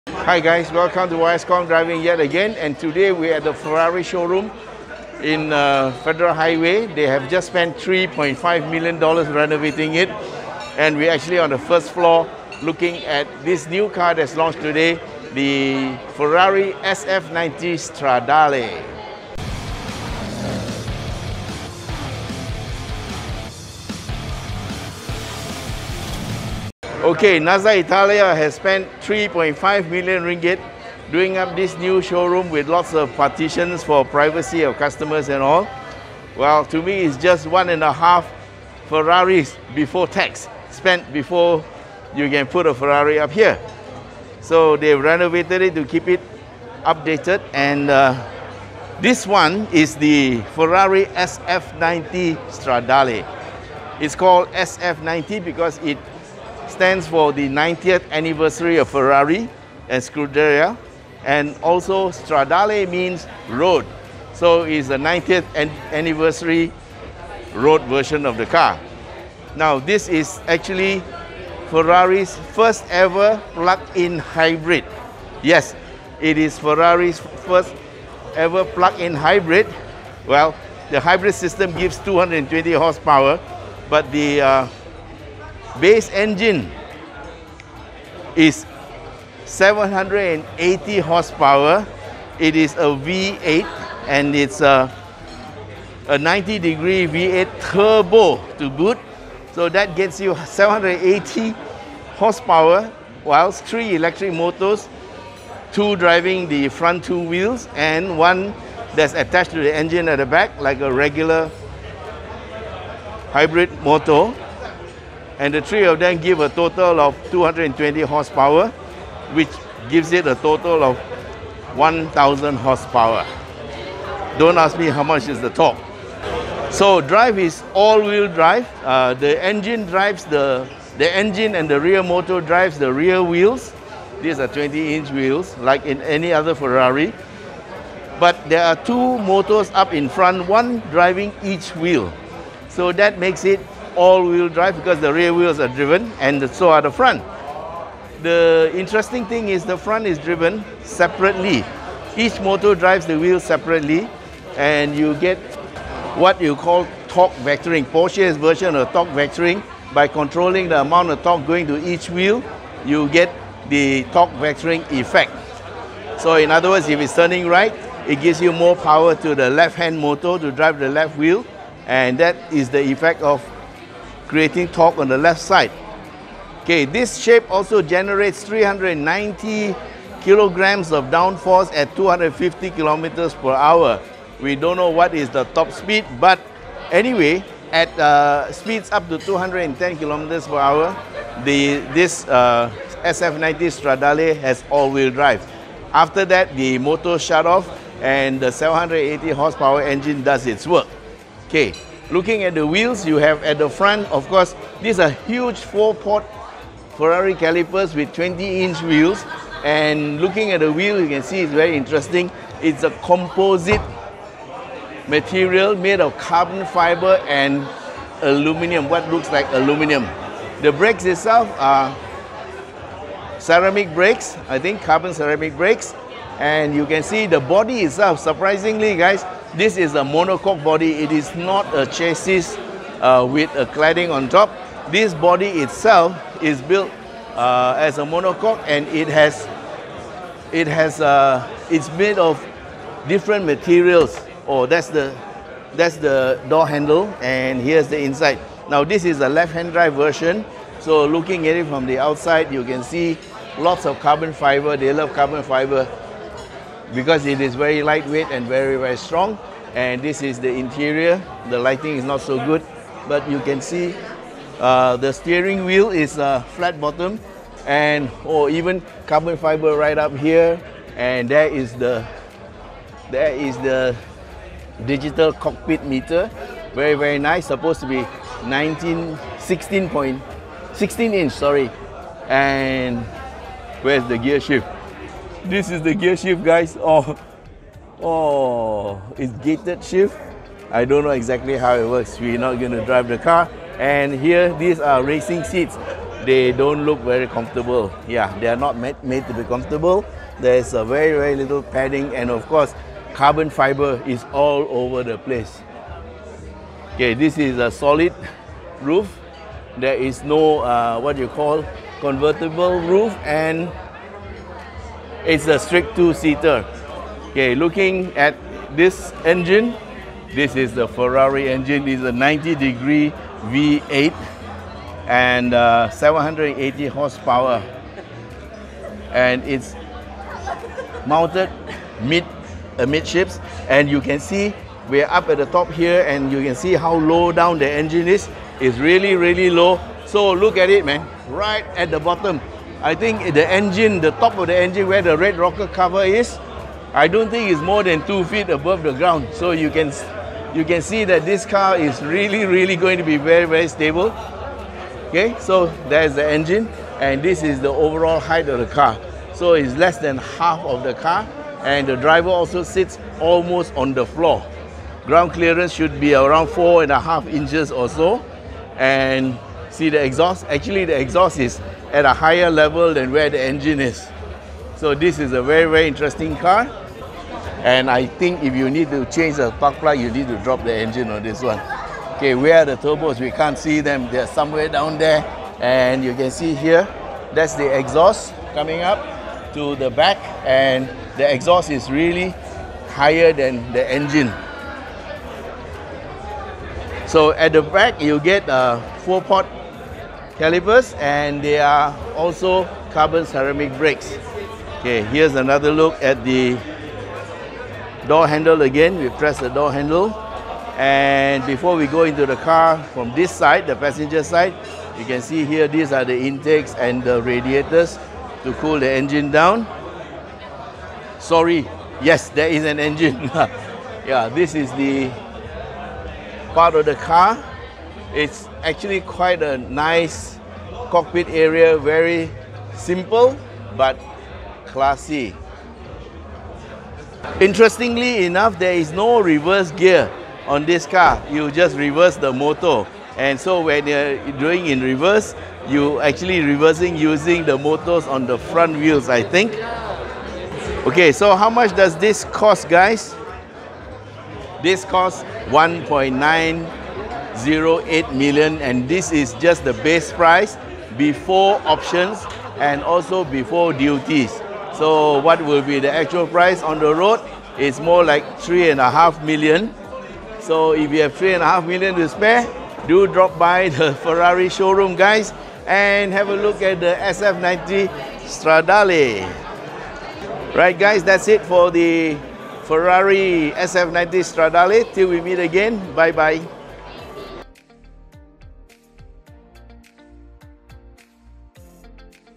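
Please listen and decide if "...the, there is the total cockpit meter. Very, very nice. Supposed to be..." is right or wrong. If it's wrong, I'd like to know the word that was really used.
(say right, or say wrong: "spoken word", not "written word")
wrong: "digital", not "total".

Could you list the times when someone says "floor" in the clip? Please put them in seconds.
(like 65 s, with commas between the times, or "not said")
11 s, 364 s.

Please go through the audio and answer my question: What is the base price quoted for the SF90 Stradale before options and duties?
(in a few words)
1.908 million.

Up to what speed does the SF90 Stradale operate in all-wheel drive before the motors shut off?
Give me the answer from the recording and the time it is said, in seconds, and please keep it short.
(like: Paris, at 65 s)
210 km/h, at 189 s.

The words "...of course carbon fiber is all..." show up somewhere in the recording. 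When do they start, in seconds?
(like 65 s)
302 s.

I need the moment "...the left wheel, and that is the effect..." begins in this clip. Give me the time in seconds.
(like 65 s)
170 s.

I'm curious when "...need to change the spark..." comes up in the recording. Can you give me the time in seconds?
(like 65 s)
378 s.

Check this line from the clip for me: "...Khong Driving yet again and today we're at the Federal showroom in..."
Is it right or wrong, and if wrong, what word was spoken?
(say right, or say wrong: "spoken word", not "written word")
wrong: "Ferrari", not "Federal".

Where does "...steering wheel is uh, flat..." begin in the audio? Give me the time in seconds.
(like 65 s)
265 s.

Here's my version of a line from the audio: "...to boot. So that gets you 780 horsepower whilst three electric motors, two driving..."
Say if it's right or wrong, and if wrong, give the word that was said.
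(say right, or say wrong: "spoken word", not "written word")
right.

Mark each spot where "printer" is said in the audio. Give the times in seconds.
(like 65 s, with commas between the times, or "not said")
not said.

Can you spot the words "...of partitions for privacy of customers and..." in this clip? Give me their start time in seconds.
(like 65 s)
32 s.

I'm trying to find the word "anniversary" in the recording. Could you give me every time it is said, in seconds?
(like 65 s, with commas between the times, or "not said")
58 s, 65 s.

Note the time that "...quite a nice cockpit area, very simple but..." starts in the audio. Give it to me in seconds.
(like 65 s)
428 s.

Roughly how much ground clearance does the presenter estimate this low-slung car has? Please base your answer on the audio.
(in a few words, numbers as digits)
4.5 inches.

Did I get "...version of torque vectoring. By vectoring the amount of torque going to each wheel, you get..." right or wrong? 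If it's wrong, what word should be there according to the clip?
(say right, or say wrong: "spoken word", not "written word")
wrong: "controlling", not "vectoring".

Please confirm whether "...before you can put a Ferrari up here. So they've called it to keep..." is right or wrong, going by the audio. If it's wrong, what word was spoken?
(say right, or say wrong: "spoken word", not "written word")
wrong: "renovated", not "called".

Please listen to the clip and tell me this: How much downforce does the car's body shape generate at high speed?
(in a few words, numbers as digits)
390 kilograms.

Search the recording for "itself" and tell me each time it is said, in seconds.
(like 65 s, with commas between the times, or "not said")
221 s, 227 s, 235 s.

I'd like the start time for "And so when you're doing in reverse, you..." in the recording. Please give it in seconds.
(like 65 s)
443 s.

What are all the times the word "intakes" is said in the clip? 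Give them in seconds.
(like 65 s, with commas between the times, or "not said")
416 s.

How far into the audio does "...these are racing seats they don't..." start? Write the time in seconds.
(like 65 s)
294 s.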